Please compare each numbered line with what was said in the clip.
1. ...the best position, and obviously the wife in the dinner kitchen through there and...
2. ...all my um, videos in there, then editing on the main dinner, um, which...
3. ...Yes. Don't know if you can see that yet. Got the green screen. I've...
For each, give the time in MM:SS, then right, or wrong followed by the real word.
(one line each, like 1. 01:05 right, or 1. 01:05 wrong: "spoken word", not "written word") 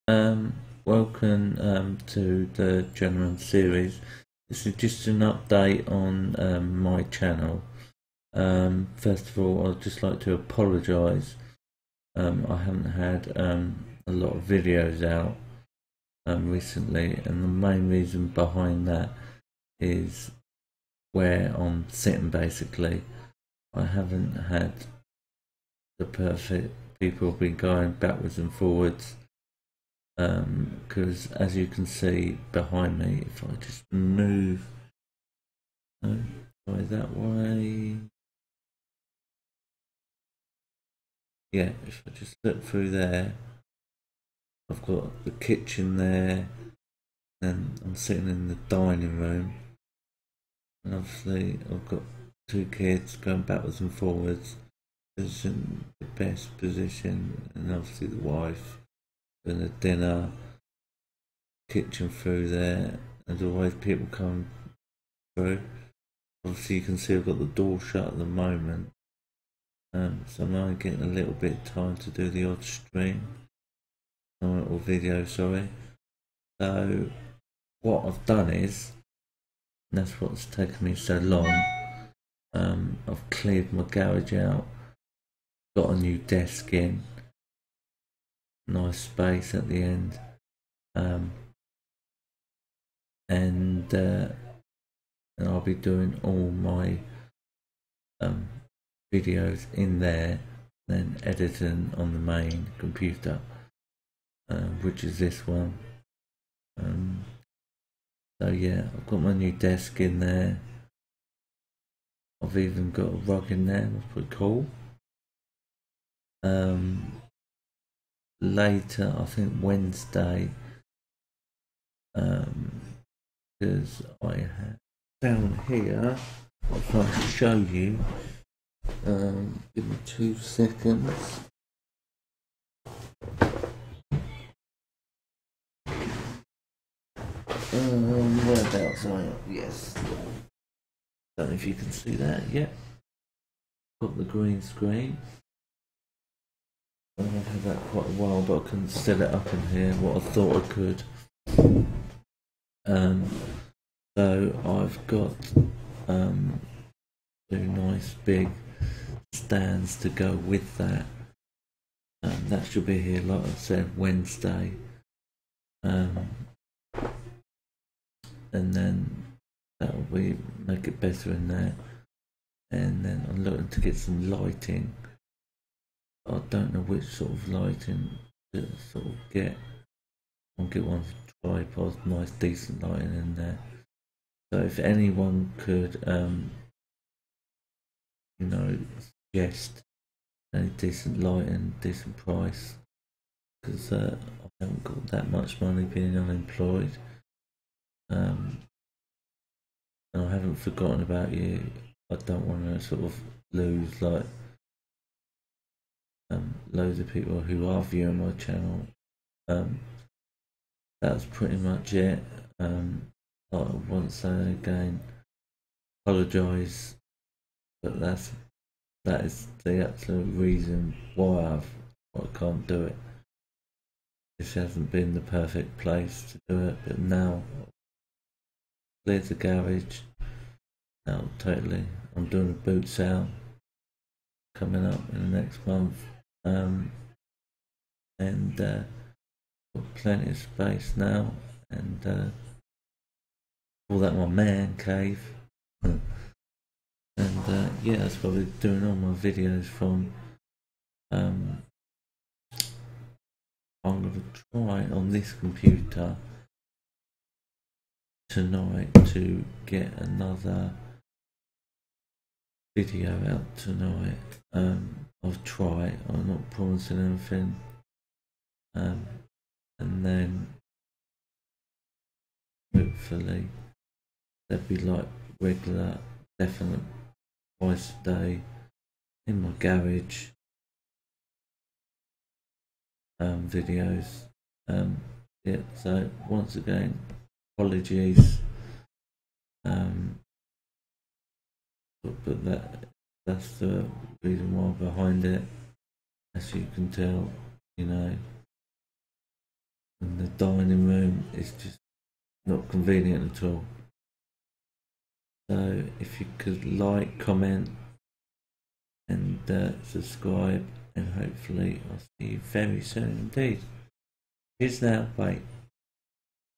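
1. 00:55 right
2. 01:36 wrong: "computer", not "dinner"
3. 02:19 right.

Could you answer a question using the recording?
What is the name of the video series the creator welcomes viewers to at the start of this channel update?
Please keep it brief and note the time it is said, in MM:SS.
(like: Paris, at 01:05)
Journeyman series, at 00:02.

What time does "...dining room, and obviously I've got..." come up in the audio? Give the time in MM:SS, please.
00:48.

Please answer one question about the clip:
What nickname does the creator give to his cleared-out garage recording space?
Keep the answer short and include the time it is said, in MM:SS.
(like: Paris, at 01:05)
man cave, at 04:04.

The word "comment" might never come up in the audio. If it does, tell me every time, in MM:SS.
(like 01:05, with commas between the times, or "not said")
05:07.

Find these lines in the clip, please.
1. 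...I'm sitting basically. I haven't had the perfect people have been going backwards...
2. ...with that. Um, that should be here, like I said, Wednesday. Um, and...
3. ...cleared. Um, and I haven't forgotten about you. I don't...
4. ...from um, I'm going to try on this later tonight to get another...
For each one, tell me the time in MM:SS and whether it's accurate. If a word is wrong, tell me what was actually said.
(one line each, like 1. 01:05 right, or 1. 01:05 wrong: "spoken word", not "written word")
1. 00:21 right
2. 02:40 right
3. 03:16 wrong: "unemployed", not "cleared"
4. 04:09 wrong: "computer", not "later".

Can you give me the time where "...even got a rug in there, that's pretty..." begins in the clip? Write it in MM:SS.
01:52.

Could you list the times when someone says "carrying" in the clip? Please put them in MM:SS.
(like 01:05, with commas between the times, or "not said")
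not said.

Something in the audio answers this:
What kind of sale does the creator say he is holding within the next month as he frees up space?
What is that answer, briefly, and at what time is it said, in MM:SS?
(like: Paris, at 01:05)
boot sale, at 03:52.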